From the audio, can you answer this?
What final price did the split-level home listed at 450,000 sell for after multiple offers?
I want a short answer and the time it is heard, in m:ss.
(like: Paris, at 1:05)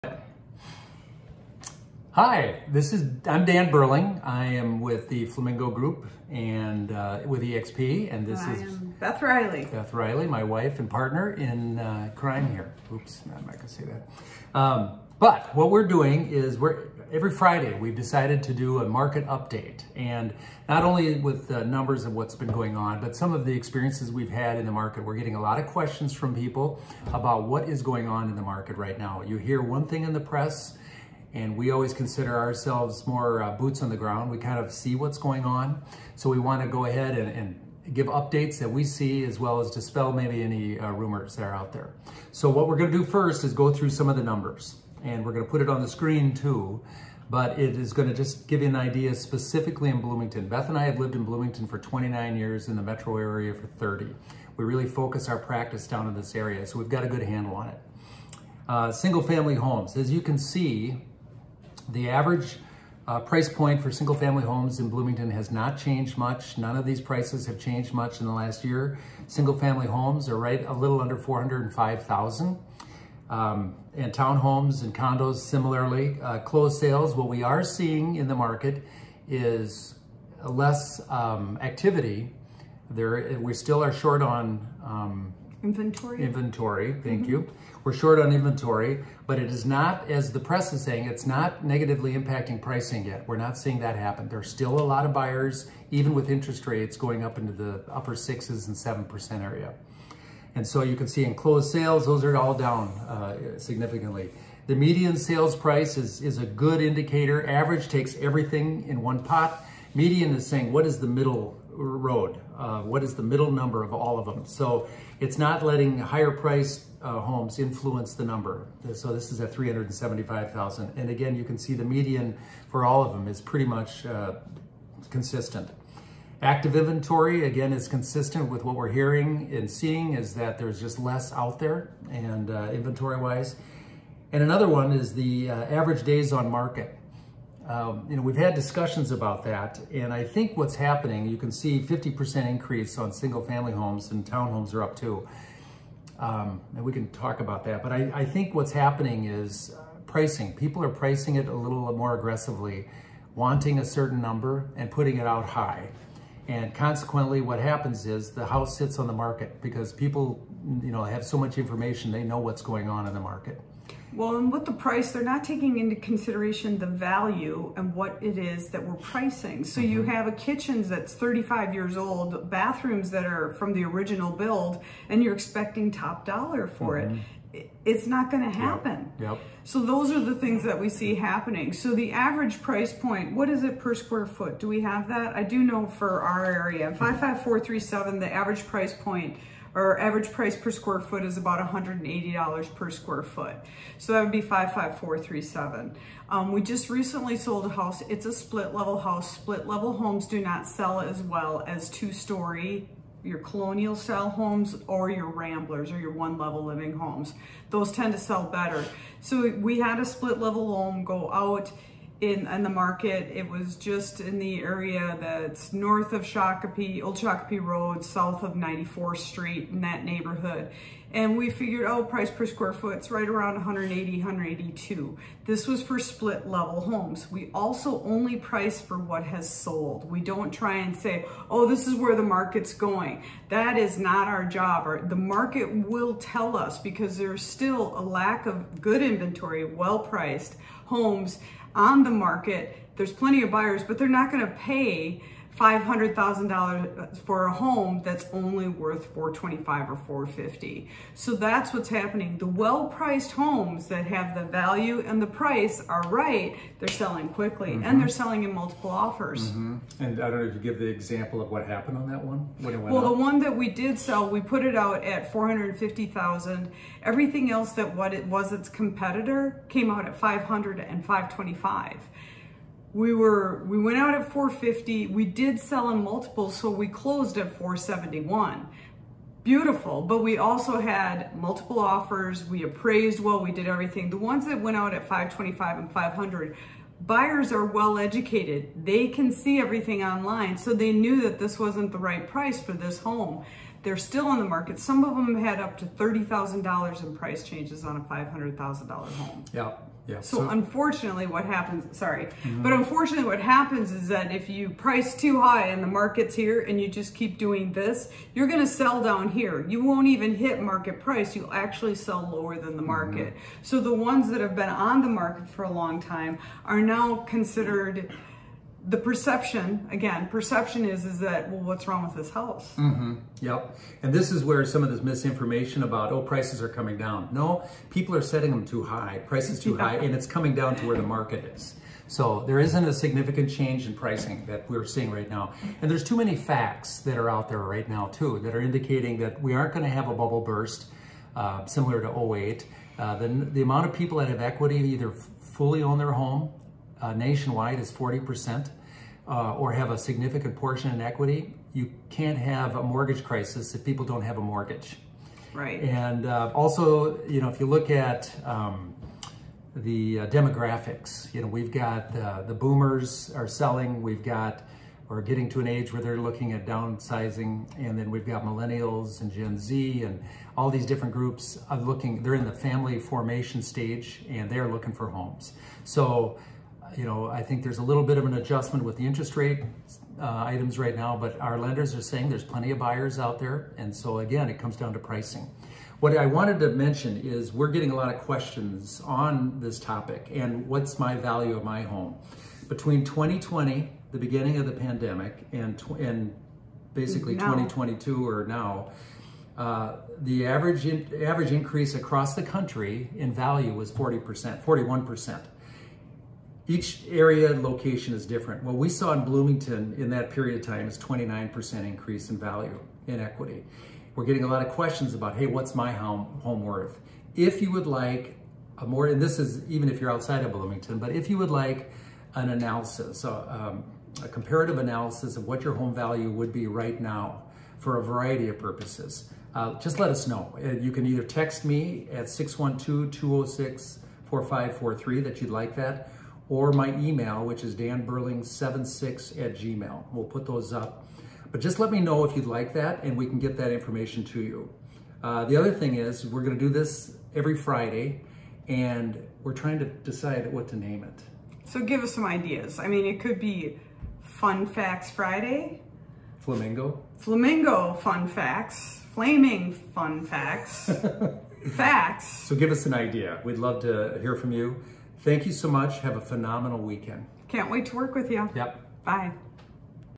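471,000, at 4:37.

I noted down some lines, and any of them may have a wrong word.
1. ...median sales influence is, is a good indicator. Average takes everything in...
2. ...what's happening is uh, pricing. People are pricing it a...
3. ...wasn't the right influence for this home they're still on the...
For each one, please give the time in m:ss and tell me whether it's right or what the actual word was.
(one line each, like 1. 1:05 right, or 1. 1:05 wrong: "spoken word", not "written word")
1. 1:44 wrong: "price", not "influence"
2. 2:28 right
3. 4:51 wrong: "price", not "influence".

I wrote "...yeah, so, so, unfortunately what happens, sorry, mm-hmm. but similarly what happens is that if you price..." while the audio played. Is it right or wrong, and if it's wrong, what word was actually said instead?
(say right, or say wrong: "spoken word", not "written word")
wrong: "unfortunately", not "similarly".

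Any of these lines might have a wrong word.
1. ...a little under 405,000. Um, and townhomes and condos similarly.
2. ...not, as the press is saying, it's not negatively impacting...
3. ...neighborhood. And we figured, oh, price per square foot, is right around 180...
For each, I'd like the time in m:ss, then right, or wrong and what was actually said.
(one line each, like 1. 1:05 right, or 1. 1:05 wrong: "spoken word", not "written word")
1. 1:10 right
2. 1:29 right
3. 3:40 right.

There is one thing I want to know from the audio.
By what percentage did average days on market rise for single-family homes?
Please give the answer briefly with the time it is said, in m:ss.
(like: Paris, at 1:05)
50%, at 2:21.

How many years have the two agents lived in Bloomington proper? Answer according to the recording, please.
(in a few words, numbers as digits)
29.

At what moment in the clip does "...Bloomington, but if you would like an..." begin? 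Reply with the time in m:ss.
7:00.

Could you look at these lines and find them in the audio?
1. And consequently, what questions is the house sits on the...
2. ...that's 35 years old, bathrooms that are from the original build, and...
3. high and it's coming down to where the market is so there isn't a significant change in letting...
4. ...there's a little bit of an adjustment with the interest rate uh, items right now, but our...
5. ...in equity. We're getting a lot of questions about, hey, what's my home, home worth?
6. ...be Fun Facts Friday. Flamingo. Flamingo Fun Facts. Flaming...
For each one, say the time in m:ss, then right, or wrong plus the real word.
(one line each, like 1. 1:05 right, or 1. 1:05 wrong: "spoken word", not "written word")
1. 2:36 wrong: "happens", not "questions"
2. 2:50 right
3. 5:29 wrong: "pricing", not "letting"
4. 6:17 right
5. 6:53 right
6. 7:33 right.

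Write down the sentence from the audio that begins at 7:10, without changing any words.
Uh, you can either text me at 612-206-4543 that you'd like that, or my email, which is danburling76 at gmail.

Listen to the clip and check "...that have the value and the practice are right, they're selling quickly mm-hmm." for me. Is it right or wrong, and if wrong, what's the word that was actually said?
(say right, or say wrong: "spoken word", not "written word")
wrong: "price", not "practice".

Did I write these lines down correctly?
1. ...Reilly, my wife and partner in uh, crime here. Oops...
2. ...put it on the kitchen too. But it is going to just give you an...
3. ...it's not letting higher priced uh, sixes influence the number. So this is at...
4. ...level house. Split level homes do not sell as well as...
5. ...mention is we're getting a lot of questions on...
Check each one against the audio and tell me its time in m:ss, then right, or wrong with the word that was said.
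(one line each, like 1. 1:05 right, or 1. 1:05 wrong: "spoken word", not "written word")
1. 0:09 right
2. 0:45 wrong: "screen", not "kitchen"
3. 1:55 wrong: "homes", not "sixes"
4. 3:18 right
5. 6:26 right.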